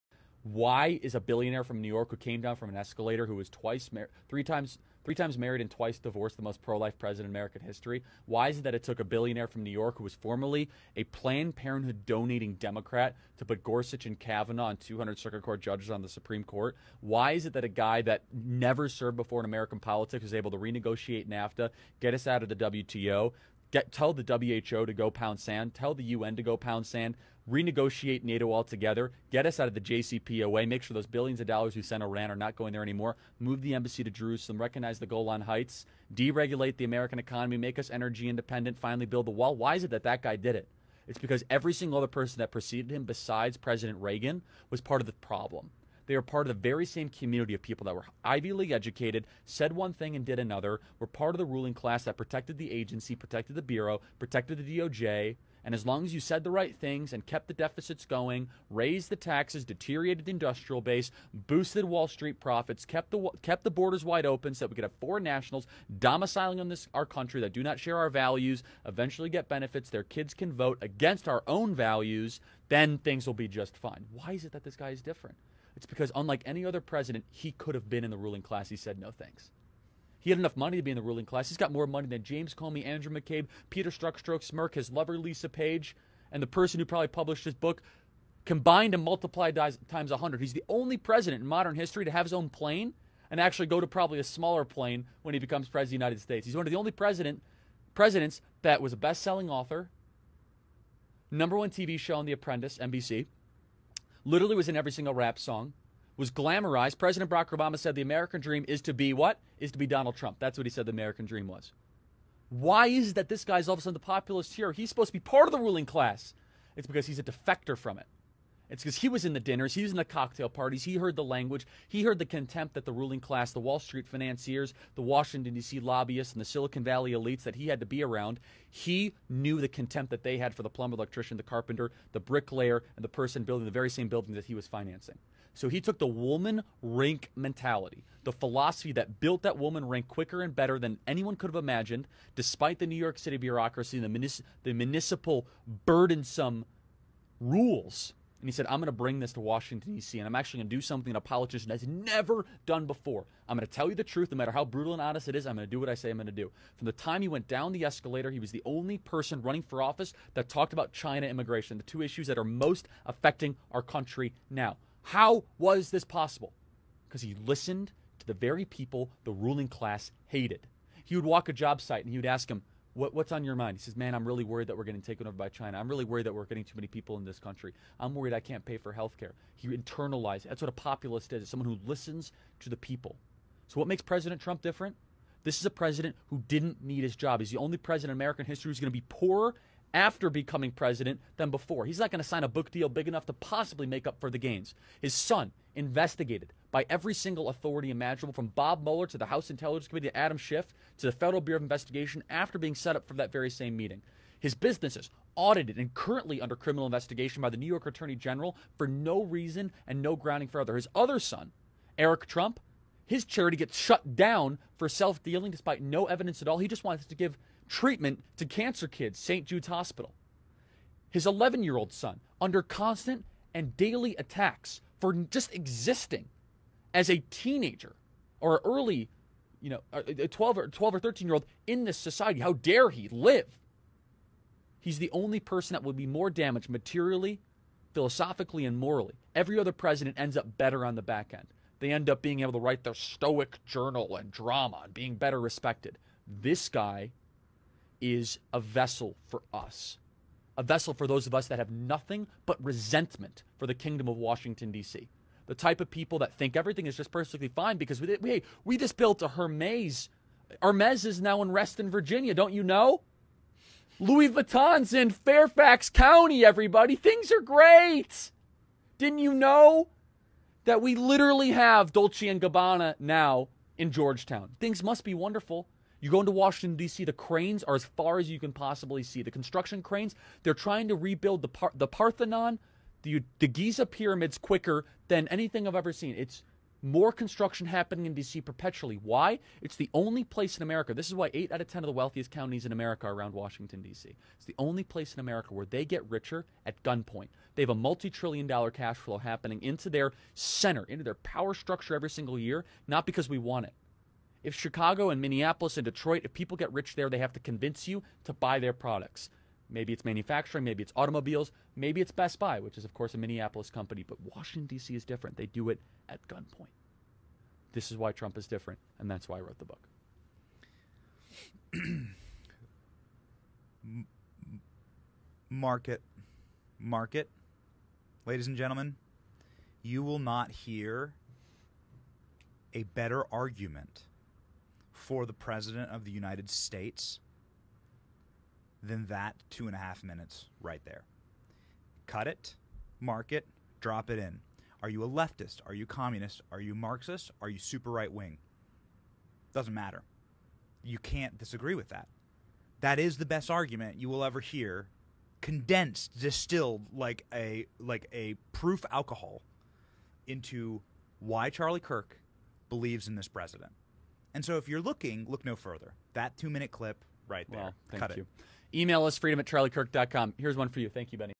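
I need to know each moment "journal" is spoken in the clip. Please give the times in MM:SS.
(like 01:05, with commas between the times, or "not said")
04:03.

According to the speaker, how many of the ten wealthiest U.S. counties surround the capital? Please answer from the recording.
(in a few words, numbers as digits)
8.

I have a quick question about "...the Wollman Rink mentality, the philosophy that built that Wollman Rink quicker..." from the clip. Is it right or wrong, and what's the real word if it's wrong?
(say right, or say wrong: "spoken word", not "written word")
right.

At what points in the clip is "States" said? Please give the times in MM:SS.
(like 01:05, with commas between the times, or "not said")
01:36, 05:36.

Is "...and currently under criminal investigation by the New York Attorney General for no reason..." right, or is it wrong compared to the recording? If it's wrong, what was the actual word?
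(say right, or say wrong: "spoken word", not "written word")
right.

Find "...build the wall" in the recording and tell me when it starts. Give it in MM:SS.
00:39.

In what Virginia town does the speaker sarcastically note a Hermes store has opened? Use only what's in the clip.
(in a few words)
Reston.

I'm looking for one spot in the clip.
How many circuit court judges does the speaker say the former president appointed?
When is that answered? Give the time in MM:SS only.
00:14.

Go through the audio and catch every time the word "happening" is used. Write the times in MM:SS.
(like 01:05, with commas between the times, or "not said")
04:47, 04:59.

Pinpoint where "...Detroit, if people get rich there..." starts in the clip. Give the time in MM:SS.
05:05.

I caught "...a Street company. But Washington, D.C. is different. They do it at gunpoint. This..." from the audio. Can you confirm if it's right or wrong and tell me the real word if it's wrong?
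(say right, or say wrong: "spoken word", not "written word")
wrong: "Minneapolis", not "Street".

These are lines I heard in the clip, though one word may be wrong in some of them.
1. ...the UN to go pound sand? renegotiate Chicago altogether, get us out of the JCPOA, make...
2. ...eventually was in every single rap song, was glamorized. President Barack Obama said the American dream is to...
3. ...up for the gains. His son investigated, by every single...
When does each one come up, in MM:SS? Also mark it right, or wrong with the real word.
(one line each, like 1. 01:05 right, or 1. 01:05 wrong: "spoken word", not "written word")
1. 00:25 wrong: "NATO", not "Chicago"
2. 01:44 wrong: "literally", not "eventually"
3. 03:14 right.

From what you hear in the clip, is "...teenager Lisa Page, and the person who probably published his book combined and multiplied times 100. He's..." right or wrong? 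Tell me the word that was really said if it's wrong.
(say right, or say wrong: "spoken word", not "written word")
wrong: "lover", not "teenager".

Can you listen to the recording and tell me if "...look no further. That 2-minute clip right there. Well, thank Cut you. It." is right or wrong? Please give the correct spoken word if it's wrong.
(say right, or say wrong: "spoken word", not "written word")
right.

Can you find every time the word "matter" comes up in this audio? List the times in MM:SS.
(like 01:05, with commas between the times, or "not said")
02:34, 05:49.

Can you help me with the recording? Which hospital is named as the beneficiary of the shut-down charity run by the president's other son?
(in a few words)
St. Jude's Hospital.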